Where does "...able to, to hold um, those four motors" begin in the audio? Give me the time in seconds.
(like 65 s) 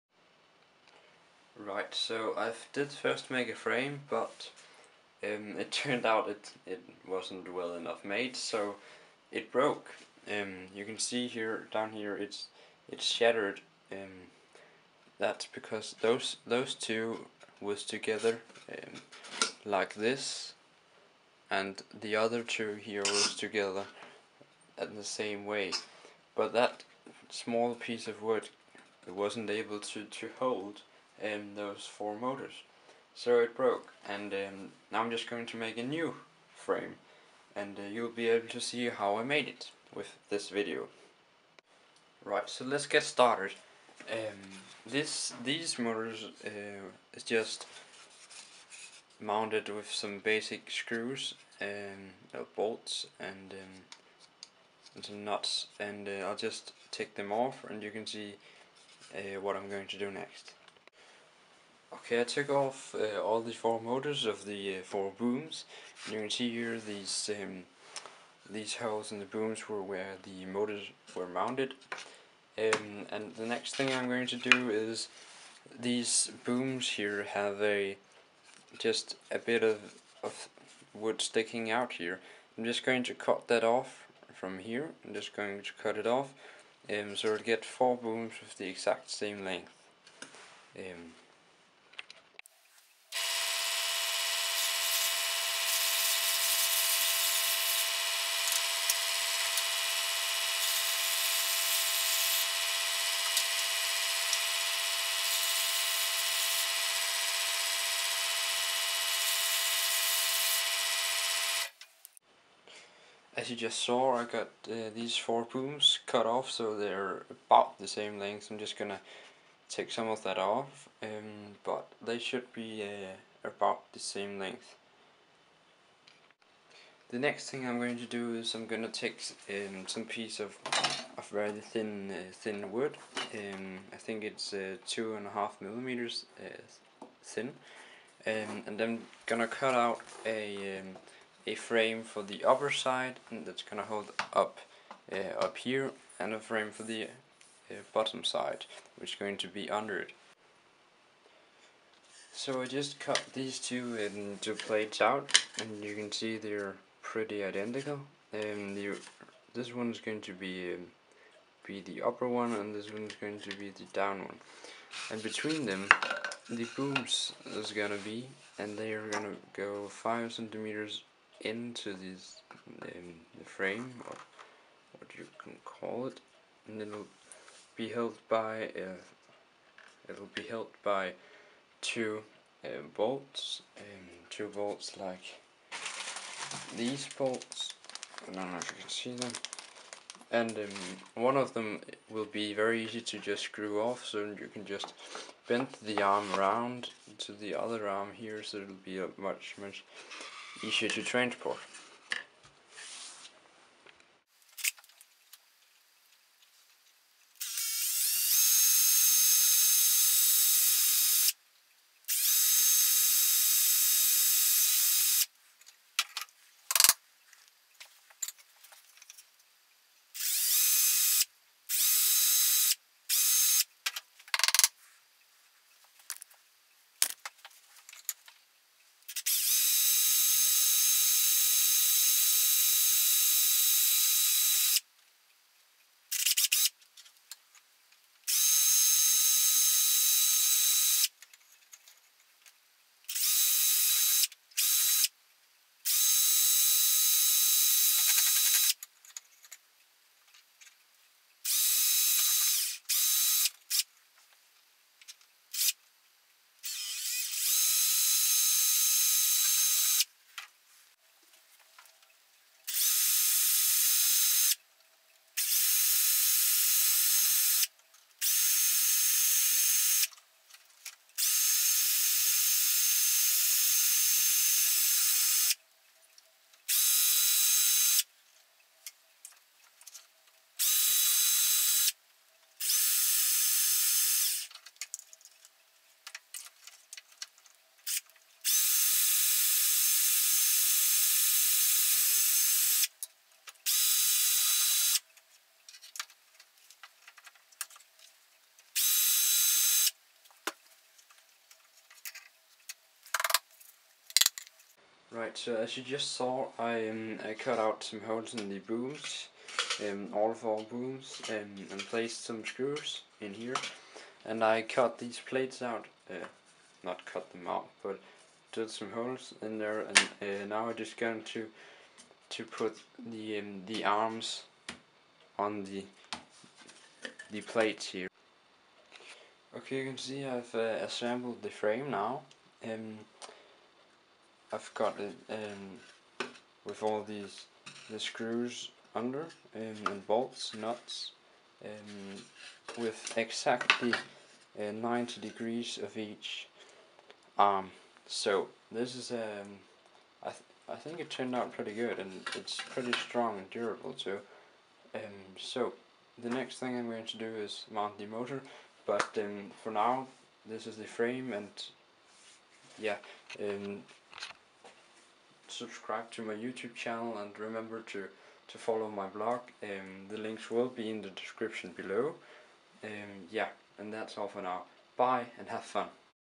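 29 s.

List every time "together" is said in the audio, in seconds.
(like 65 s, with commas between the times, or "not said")
17 s, 23 s.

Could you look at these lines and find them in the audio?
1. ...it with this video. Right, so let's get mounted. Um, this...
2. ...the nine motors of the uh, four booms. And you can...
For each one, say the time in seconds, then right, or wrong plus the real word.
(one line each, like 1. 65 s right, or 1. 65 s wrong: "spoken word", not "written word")
1. 39 s wrong: "started", not "mounted"
2. 63 s wrong: "four", not "nine".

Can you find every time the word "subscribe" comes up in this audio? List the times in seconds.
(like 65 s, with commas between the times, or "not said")
365 s.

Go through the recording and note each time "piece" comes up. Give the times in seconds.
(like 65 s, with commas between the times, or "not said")
27 s, 130 s.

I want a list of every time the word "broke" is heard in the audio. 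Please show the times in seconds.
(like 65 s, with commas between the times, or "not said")
9 s, 33 s.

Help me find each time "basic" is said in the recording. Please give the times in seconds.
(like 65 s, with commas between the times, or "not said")
50 s.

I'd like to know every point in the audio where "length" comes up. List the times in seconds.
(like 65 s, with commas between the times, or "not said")
89 s, 118 s, 124 s.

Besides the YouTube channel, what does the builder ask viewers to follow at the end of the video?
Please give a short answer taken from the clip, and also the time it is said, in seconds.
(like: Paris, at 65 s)
blog, at 369 s.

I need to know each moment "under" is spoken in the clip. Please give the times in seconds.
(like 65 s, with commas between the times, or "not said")
149 s, 338 s.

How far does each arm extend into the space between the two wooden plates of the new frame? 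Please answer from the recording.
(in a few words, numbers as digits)
5 centimeters.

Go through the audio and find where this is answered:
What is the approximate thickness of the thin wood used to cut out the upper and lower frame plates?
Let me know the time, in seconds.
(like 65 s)
134 s.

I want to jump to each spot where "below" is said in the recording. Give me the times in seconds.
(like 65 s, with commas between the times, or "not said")
371 s.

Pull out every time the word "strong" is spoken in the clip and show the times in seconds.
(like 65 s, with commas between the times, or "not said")
352 s.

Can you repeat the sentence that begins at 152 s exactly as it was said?
So I just cut these two into plates out and you can see they're pretty identical.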